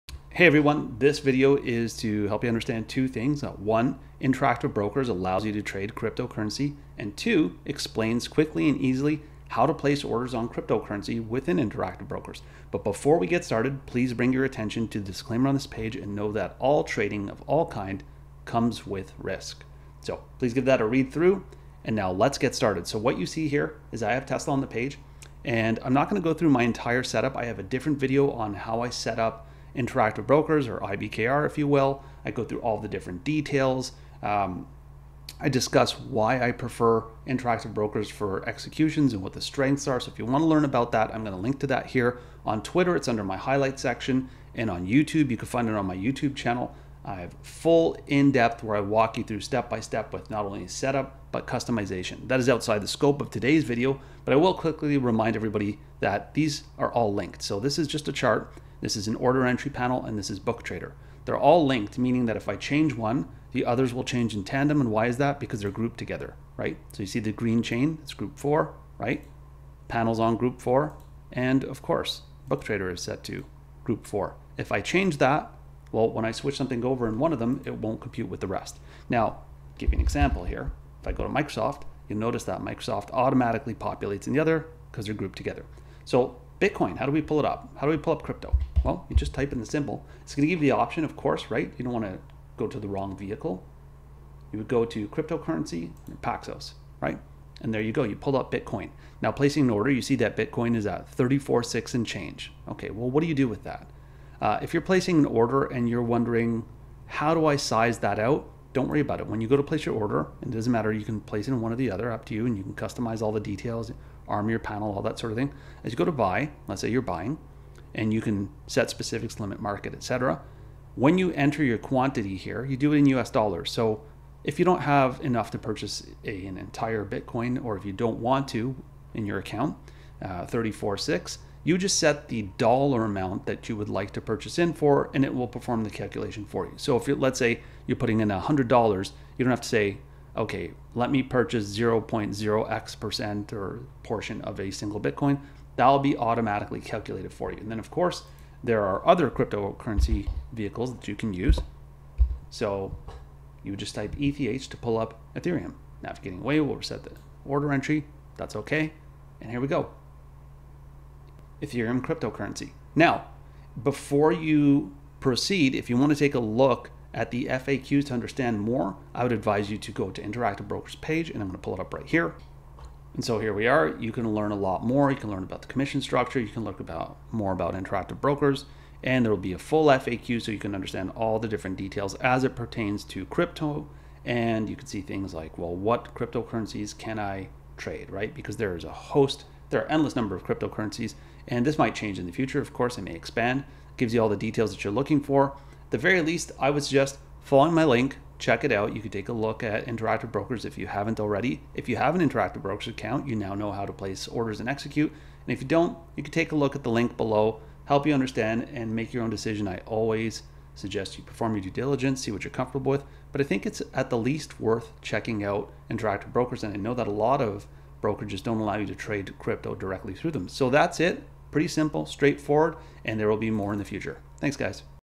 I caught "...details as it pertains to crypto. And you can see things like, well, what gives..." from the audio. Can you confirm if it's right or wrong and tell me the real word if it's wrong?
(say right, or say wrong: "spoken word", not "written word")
wrong: "cryptocurrencies", not "gives".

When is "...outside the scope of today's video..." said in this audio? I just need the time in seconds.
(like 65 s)
52 s.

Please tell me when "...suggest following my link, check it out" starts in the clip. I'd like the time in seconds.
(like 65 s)
196 s.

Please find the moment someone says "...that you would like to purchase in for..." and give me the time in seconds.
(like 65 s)
133 s.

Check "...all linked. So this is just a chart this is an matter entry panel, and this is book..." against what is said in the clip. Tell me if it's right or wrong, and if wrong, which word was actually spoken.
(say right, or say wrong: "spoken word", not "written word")
wrong: "order", not "matter".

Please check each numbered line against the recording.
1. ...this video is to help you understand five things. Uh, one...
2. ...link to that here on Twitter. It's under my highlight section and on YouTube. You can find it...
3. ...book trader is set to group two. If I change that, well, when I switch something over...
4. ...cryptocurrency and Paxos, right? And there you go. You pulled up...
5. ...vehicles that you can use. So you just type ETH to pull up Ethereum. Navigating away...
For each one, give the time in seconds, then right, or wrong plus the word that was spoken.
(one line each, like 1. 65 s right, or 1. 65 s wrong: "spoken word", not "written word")
1. 0 s wrong: "two", not "five"
2. 41 s right
3. 72 s wrong: "four", not "two"
4. 95 s right
5. 150 s right.